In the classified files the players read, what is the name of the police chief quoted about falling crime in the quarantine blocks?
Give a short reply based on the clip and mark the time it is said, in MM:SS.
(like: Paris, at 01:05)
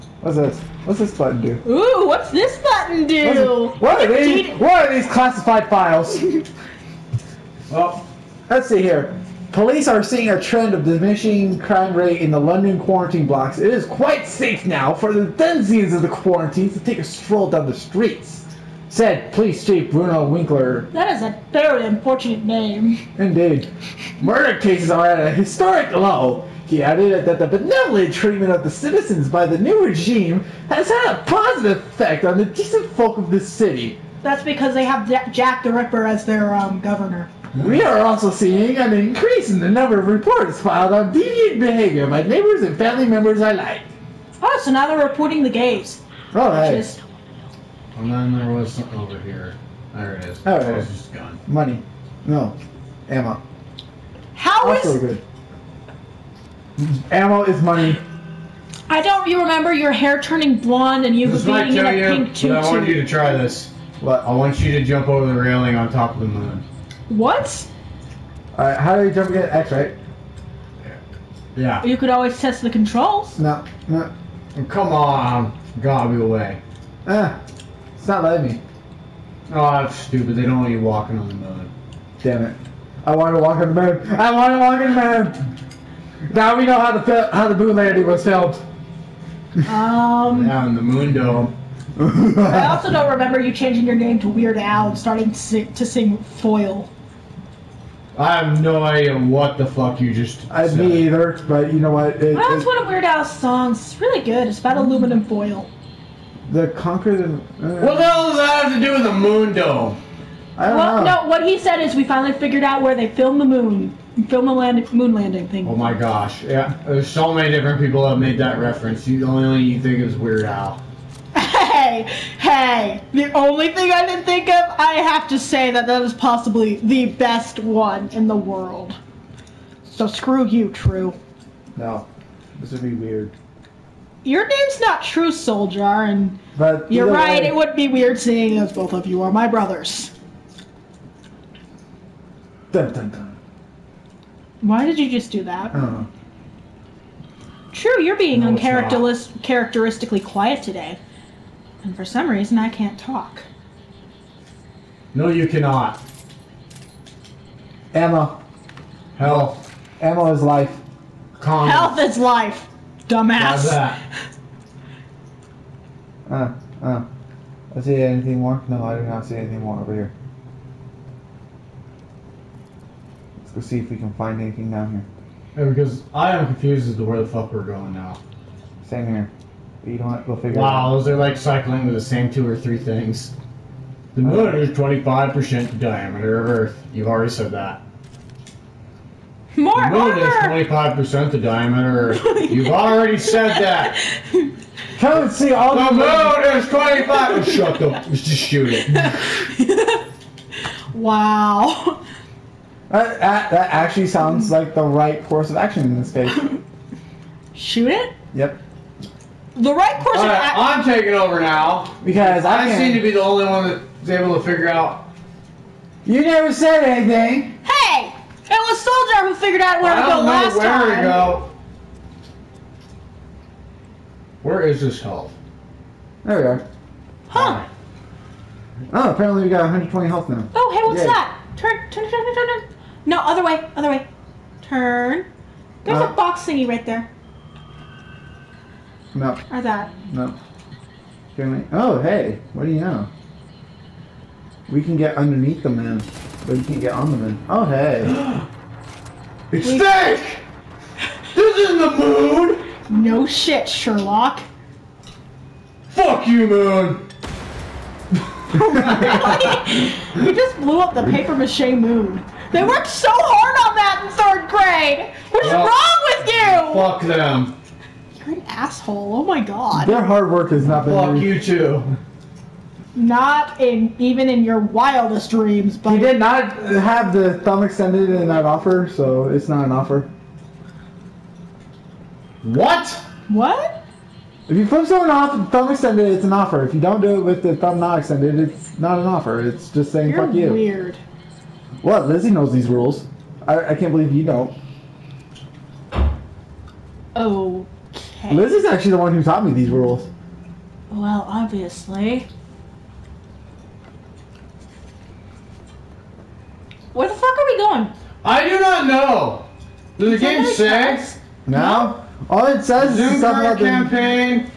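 Bruno Winkler, at 00:19.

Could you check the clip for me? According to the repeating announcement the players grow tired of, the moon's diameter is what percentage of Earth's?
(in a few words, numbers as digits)
25%.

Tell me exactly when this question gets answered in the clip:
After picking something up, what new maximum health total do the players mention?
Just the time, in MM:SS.
03:49.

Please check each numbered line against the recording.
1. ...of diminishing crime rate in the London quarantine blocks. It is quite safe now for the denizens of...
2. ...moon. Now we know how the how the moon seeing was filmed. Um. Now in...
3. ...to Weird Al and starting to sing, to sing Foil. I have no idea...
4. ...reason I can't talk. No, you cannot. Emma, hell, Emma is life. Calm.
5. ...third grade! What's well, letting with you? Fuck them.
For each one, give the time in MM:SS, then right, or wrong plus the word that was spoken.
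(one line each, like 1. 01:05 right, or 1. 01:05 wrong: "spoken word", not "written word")
1. 00:10 right
2. 01:25 wrong: "landing", not "seeing"
3. 01:34 right
4. 02:32 right
5. 04:24 wrong: "wrong", not "letting".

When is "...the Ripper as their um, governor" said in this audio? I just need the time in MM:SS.
00:35.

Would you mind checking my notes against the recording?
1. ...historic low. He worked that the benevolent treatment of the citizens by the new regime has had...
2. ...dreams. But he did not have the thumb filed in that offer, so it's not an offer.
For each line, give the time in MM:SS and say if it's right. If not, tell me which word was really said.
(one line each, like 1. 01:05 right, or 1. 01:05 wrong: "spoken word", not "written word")
1. 00:25 wrong: "added", not "worked"
2. 04:35 wrong: "extended", not "filed".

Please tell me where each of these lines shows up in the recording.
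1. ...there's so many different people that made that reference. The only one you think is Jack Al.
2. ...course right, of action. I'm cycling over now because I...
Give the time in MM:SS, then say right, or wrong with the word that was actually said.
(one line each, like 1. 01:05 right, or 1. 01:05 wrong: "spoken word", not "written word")
1. 01:56 wrong: "Weird", not "Jack"
2. 03:30 wrong: "taking", not "cycling".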